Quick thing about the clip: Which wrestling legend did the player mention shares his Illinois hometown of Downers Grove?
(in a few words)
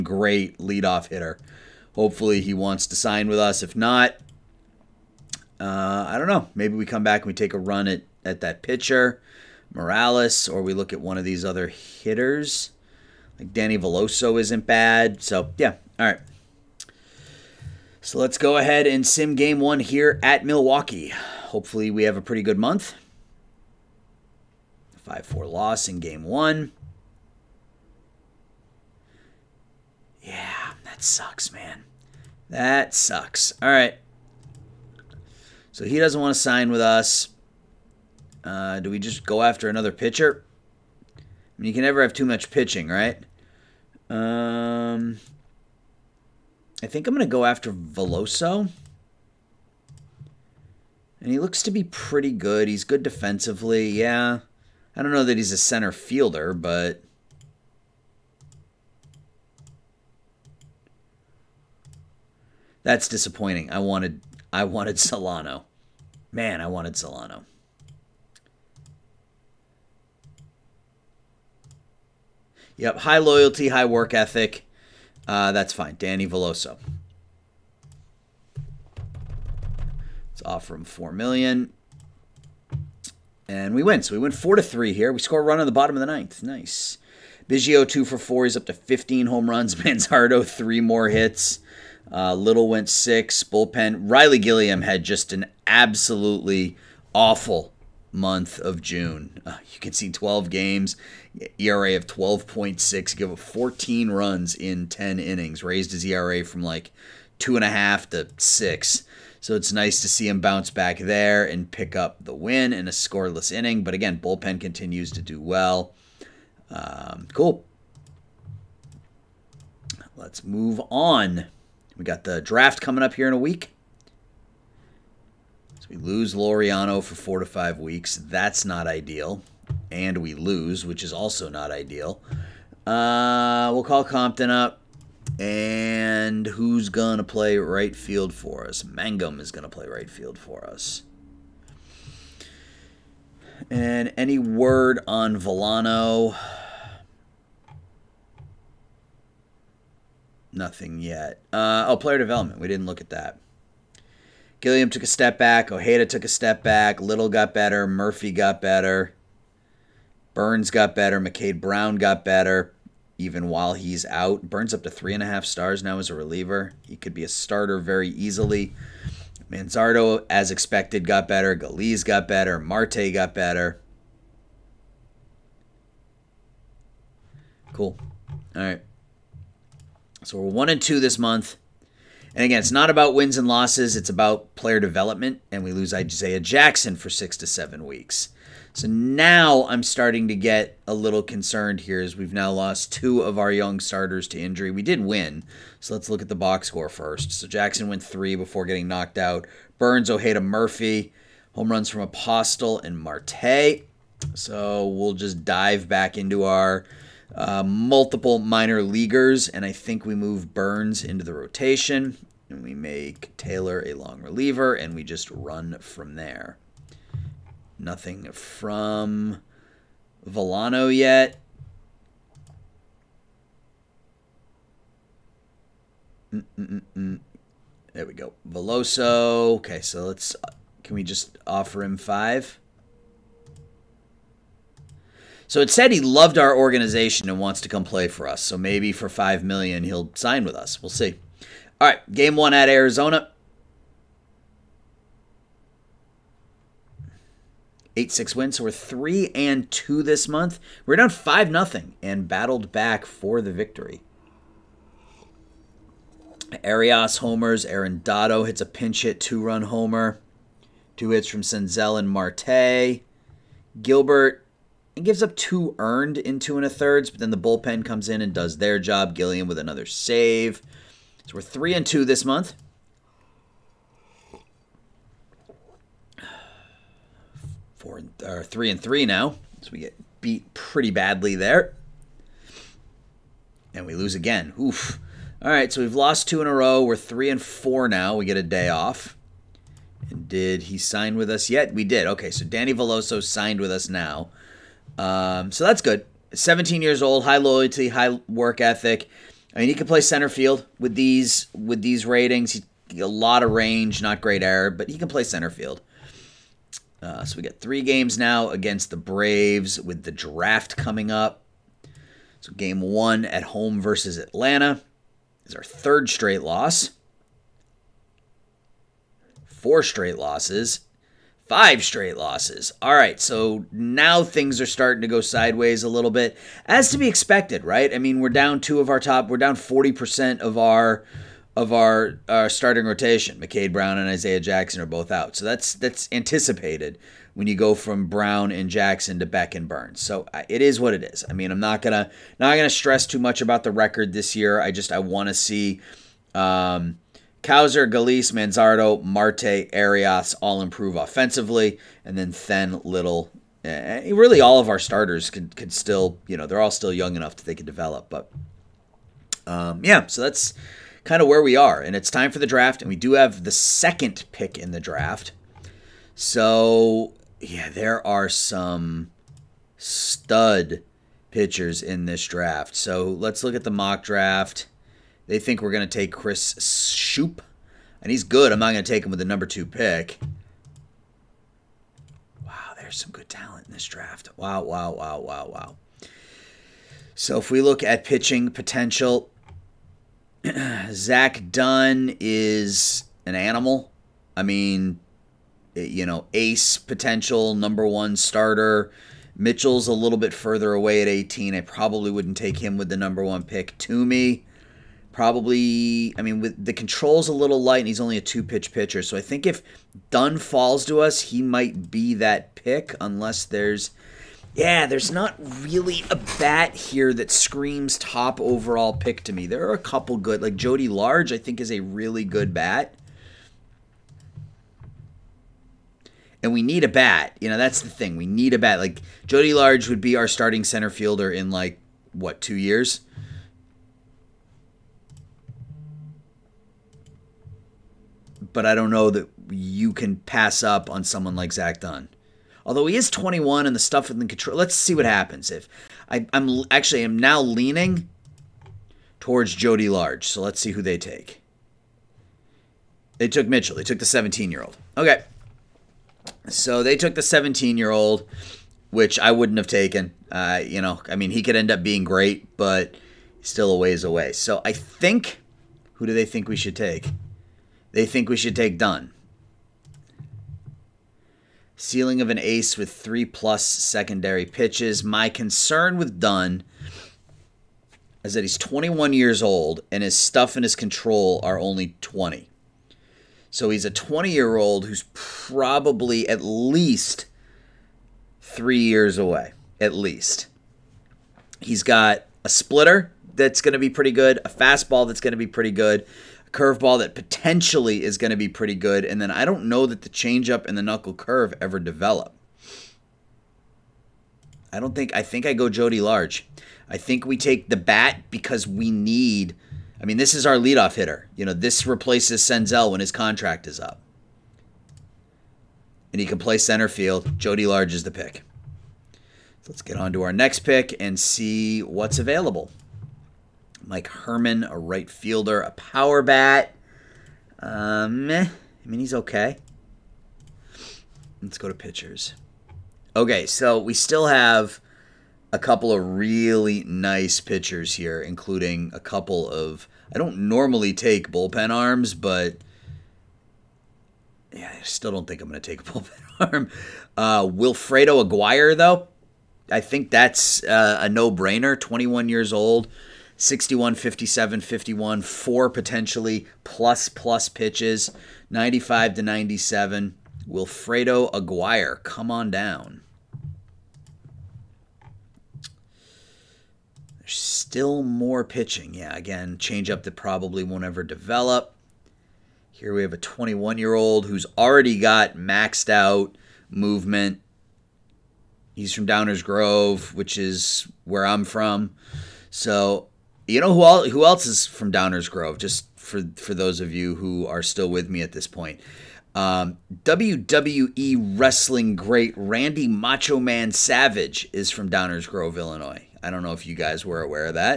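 Randy Macho Man Savage.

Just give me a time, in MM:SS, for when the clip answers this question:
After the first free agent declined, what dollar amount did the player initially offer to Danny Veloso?
01:20.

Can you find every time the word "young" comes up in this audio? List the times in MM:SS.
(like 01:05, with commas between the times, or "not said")
03:13, 05:56.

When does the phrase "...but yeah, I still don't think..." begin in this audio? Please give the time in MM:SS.
09:02.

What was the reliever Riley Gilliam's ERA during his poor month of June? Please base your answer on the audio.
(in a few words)
12.6.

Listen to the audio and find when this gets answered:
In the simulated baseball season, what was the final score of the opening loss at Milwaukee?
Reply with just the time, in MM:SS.
00:25.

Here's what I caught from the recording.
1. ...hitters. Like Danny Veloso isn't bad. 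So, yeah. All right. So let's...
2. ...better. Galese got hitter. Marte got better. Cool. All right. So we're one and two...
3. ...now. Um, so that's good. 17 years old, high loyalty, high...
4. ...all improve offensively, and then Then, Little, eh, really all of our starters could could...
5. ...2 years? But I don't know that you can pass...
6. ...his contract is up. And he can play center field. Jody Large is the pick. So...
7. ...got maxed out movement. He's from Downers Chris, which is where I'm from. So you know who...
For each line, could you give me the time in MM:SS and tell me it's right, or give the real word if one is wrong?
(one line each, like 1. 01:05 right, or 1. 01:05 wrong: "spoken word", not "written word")
1. 00:11 right
2. 02:51 wrong: "better", not "hitter"
3. 04:53 right
4. 05:50 right
5. 07:12 right
6. 08:32 right
7. 09:34 wrong: "Grove", not "Chris".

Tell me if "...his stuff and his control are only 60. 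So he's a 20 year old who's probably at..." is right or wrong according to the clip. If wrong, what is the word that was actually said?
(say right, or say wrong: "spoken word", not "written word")
wrong: "20", not "60".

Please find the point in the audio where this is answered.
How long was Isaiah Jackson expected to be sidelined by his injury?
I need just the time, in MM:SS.
03:07.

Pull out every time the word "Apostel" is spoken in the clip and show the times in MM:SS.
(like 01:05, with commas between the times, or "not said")
03:22.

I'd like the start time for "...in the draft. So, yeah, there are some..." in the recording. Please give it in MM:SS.
06:04.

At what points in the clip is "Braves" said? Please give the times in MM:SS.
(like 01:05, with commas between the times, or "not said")
05:08.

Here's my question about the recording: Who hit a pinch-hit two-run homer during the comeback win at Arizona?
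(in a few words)
Arredondo.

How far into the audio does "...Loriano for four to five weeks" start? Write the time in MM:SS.
02:06.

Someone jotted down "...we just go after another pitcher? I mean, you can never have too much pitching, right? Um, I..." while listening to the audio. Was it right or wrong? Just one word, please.
right.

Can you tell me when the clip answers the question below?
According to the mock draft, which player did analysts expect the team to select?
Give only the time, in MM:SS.
06:16.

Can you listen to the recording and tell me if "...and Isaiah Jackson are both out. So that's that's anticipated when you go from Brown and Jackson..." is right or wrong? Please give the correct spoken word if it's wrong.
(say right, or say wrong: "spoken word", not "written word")
right.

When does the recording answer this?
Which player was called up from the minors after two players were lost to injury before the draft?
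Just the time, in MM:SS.
02:14.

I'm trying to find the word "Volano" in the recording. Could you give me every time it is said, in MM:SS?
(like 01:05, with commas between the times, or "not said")
02:25, 03:40.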